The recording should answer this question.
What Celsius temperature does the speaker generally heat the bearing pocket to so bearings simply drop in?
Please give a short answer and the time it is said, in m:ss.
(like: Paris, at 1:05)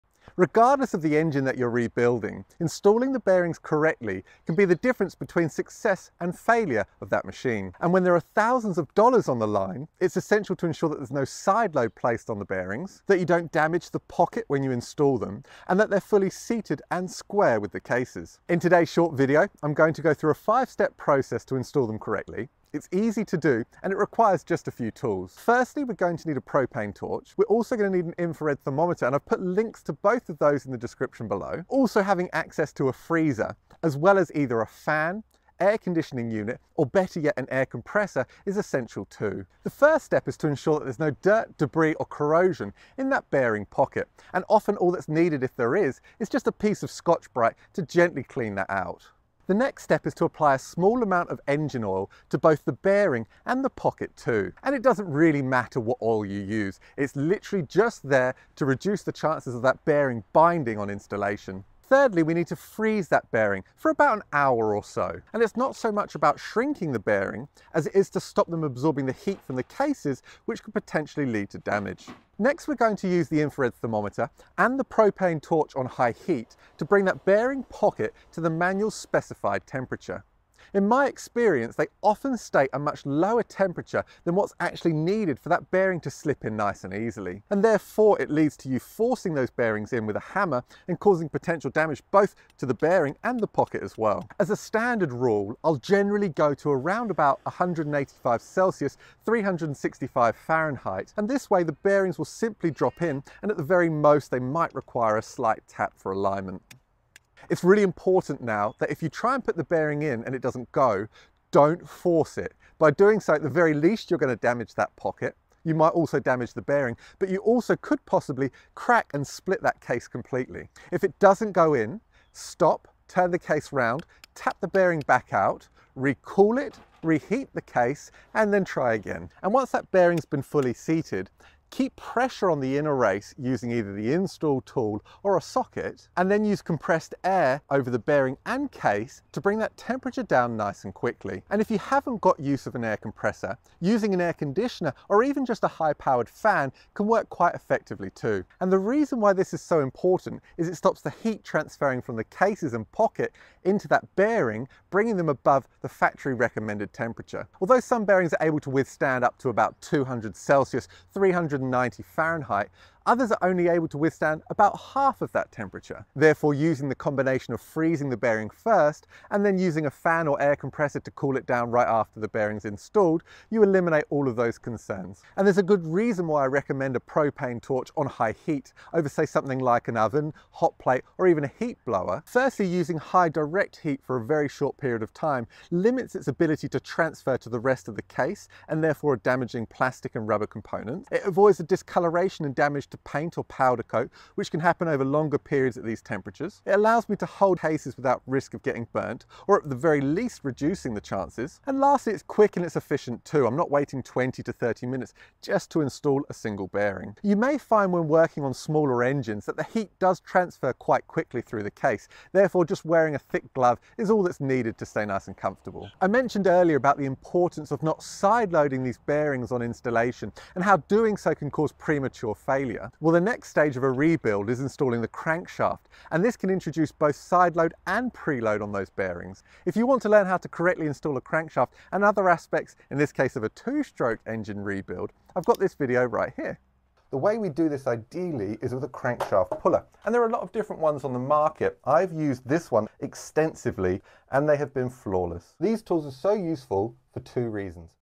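185 Celsius, at 1:37.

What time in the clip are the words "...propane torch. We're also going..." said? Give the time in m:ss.
0:26.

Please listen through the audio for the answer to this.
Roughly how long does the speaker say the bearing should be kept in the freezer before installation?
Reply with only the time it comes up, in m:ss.
1:03.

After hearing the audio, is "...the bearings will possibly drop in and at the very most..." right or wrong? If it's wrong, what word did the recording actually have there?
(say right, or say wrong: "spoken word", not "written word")
wrong: "simply", not "possibly".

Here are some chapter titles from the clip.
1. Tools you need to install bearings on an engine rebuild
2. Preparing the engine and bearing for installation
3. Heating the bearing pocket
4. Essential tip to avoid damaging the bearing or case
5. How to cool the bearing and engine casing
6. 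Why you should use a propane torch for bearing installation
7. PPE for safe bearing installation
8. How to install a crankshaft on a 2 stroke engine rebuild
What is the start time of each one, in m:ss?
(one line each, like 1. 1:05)
1. 0:25
2. 0:39
3. 1:12
4. 1:47
5. 2:10
6. 2:55
7. 3:33
8. 3:50.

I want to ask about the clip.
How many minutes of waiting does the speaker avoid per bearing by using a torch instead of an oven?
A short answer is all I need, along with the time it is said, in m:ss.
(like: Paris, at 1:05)
20 to 30 minutes, at 3:24.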